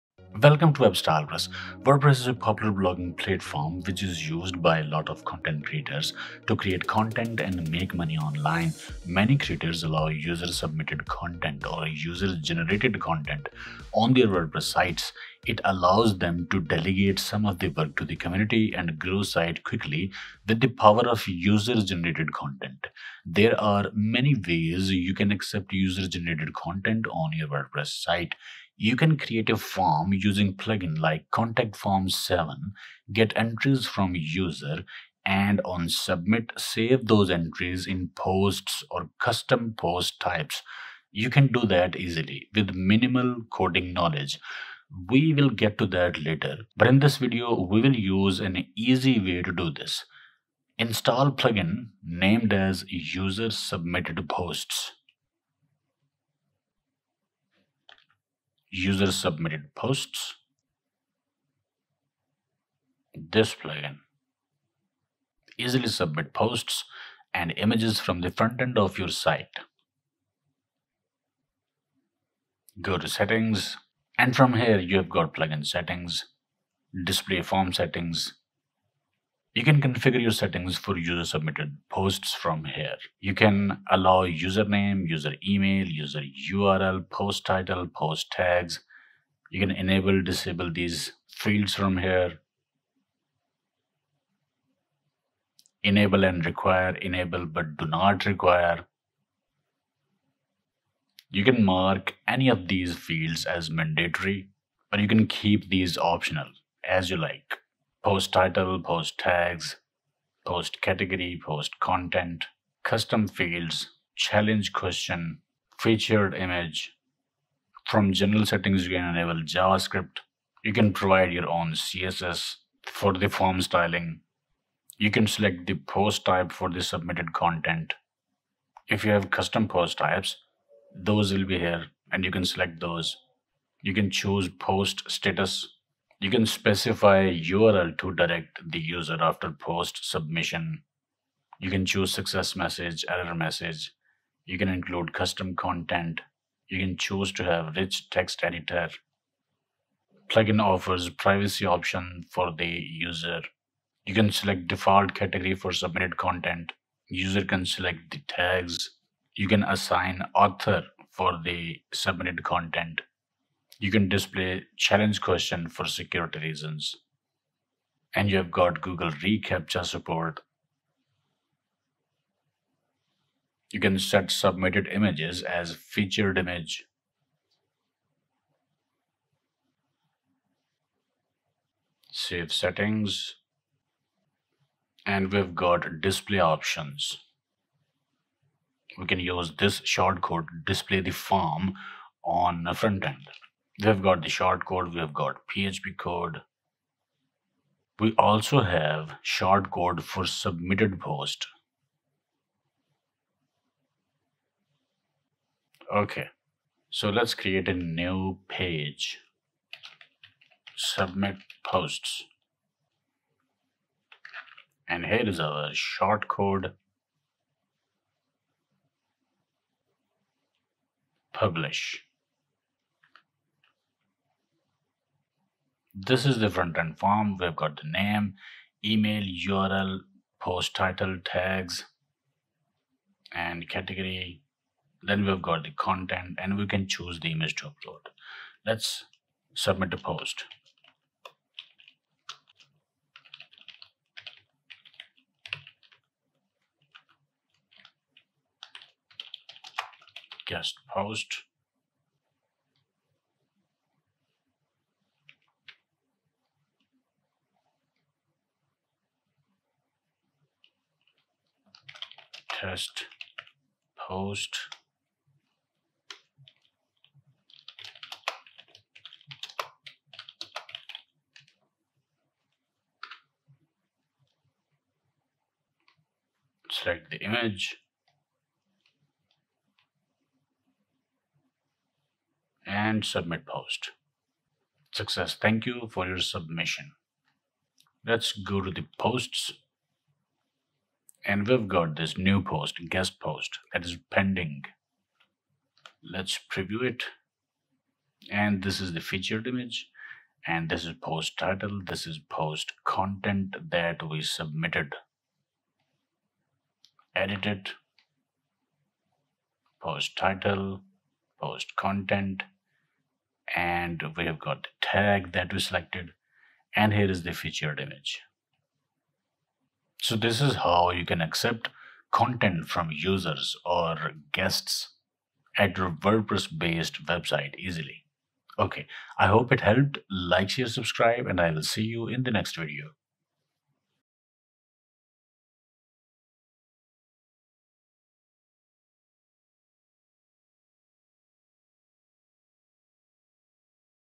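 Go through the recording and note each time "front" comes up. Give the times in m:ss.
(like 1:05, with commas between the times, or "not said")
1:08, 3:12, 3:46.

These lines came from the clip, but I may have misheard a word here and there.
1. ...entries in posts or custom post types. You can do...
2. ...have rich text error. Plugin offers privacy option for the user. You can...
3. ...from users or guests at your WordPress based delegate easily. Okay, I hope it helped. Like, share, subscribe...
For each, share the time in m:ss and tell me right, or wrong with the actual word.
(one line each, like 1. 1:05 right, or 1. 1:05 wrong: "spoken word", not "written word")
1. 0:37 right
2. 2:27 wrong: "editor", not "error"
3. 5:22 wrong: "website", not "delegate".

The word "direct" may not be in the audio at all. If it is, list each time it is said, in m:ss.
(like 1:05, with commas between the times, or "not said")
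2:18.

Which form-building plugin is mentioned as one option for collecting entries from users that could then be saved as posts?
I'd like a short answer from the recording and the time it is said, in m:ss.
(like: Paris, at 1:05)
Contact Form 7, at 0:31.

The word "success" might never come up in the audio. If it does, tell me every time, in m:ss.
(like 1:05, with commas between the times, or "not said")
2:22, 4:45.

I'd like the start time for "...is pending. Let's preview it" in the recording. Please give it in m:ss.
4:53.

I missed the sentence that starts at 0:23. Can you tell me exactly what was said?
There are many ways you can accept user-generated content on your WordPress site.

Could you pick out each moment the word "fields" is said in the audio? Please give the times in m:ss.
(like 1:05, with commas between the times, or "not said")
1:31, 1:42, 1:53.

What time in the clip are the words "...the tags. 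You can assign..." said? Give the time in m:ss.
2:38.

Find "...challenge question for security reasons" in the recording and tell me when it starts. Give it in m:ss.
2:44.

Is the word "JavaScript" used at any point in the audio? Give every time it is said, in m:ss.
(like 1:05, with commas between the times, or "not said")
1:59.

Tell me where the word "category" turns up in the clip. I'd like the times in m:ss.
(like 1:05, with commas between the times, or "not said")
1:50, 2:35, 3:53.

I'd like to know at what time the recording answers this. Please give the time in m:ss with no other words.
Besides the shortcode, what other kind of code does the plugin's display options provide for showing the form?
3:15.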